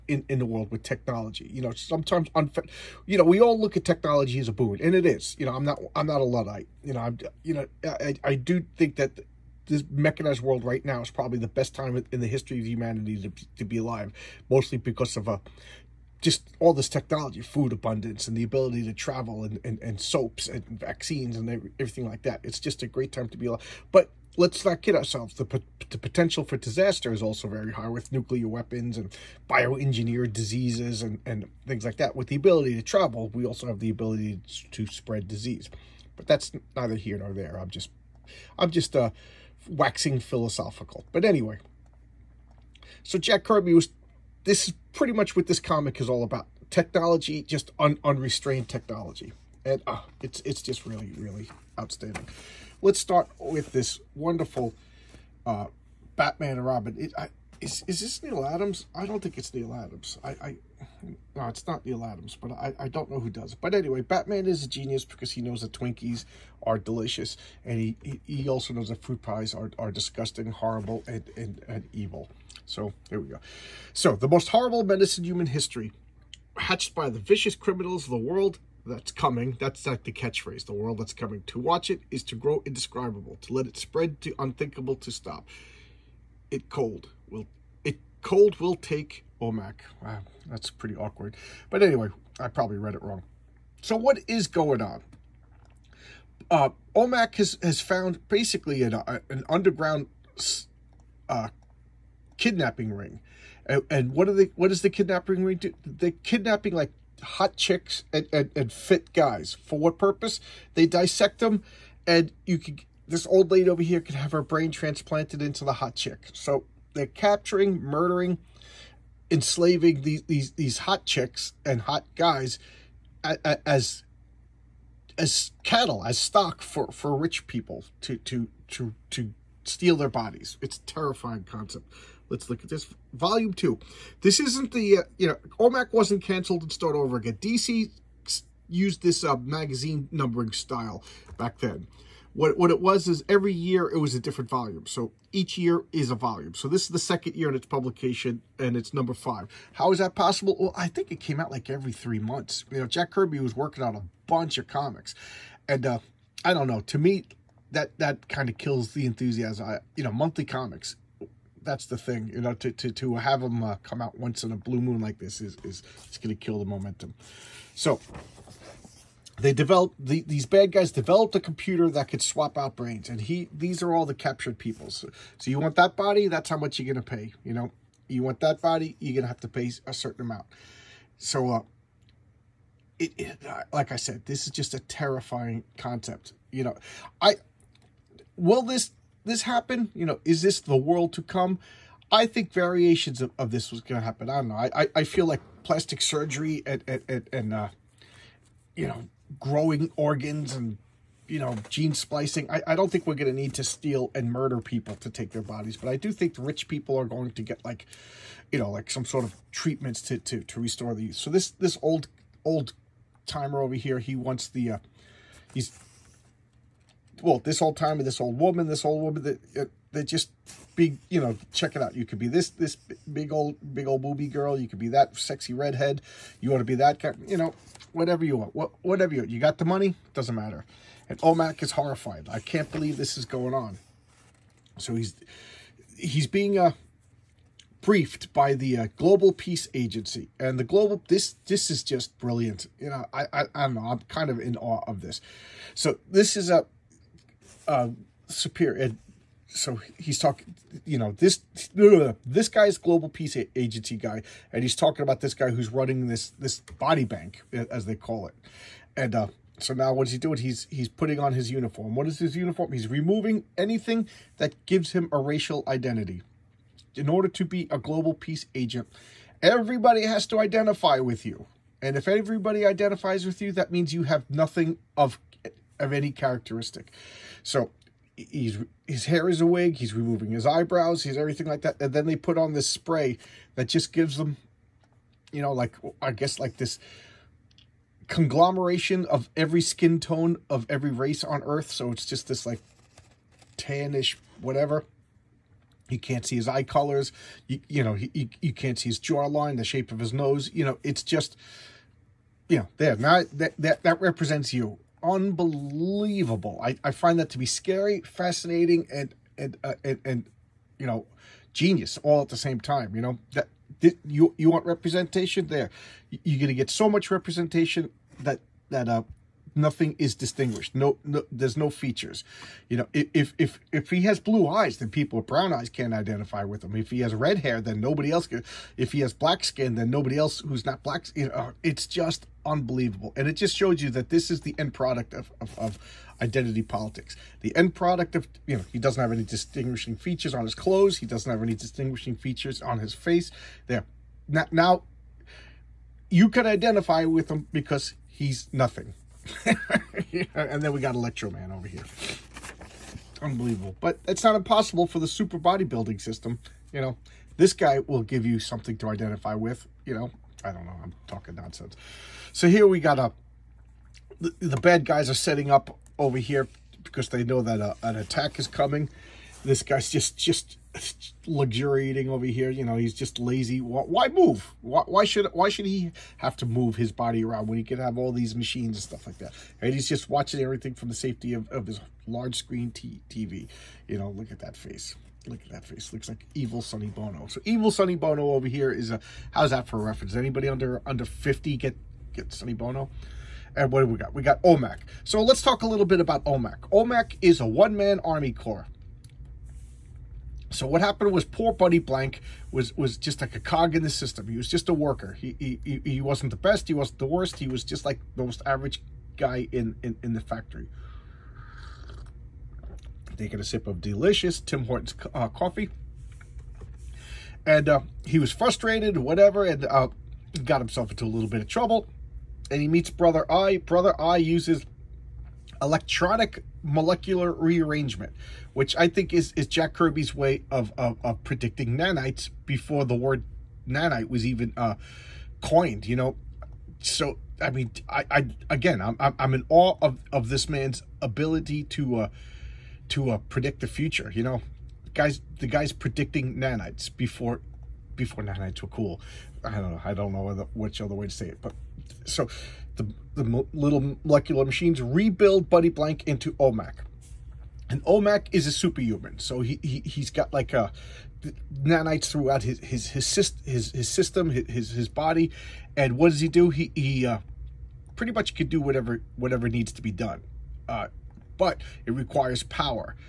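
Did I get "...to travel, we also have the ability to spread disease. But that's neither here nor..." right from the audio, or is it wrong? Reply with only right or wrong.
right.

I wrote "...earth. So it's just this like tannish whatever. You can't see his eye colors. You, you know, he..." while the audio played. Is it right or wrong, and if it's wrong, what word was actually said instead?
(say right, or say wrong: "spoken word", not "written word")
right.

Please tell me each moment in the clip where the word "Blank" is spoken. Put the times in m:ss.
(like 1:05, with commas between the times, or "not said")
6:41, 7:35.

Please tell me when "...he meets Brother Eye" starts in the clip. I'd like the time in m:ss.
7:02.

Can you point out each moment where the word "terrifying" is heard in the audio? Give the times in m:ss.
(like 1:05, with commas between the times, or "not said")
2:10, 3:04.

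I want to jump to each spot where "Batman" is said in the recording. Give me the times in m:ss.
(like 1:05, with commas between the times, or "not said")
0:56, 1:04.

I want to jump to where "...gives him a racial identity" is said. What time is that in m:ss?
4:24.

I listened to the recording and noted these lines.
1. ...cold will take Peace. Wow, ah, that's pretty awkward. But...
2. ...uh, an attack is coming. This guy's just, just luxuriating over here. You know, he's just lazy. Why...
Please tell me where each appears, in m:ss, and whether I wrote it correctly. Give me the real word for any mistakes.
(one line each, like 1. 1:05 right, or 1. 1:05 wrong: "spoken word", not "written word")
1. 1:28 wrong: "OMAC", not "Peace"
2. 6:07 right.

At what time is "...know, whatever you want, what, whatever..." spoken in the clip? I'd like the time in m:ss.
3:47.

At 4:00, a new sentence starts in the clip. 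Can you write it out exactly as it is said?
And the global, this this is just brilliant.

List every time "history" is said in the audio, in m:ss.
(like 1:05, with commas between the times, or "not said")
0:12, 1:15.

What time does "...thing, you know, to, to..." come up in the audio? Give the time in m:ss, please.
2:41.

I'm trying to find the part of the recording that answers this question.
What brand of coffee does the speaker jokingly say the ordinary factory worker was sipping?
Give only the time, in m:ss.
6:54.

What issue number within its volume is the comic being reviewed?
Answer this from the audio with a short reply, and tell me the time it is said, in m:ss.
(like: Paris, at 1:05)
5, at 2:28.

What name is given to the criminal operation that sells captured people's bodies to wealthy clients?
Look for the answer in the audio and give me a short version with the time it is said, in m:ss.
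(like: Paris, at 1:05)
body bank, at 4:16.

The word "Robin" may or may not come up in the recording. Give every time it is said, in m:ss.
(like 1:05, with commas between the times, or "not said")
0:56.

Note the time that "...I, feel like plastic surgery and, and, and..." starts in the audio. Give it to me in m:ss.
3:14.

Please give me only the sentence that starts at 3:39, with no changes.
uh, they're just big, you know, check it out.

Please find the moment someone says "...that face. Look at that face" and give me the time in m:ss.
6:24.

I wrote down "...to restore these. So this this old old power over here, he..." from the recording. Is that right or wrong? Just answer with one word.
wrong.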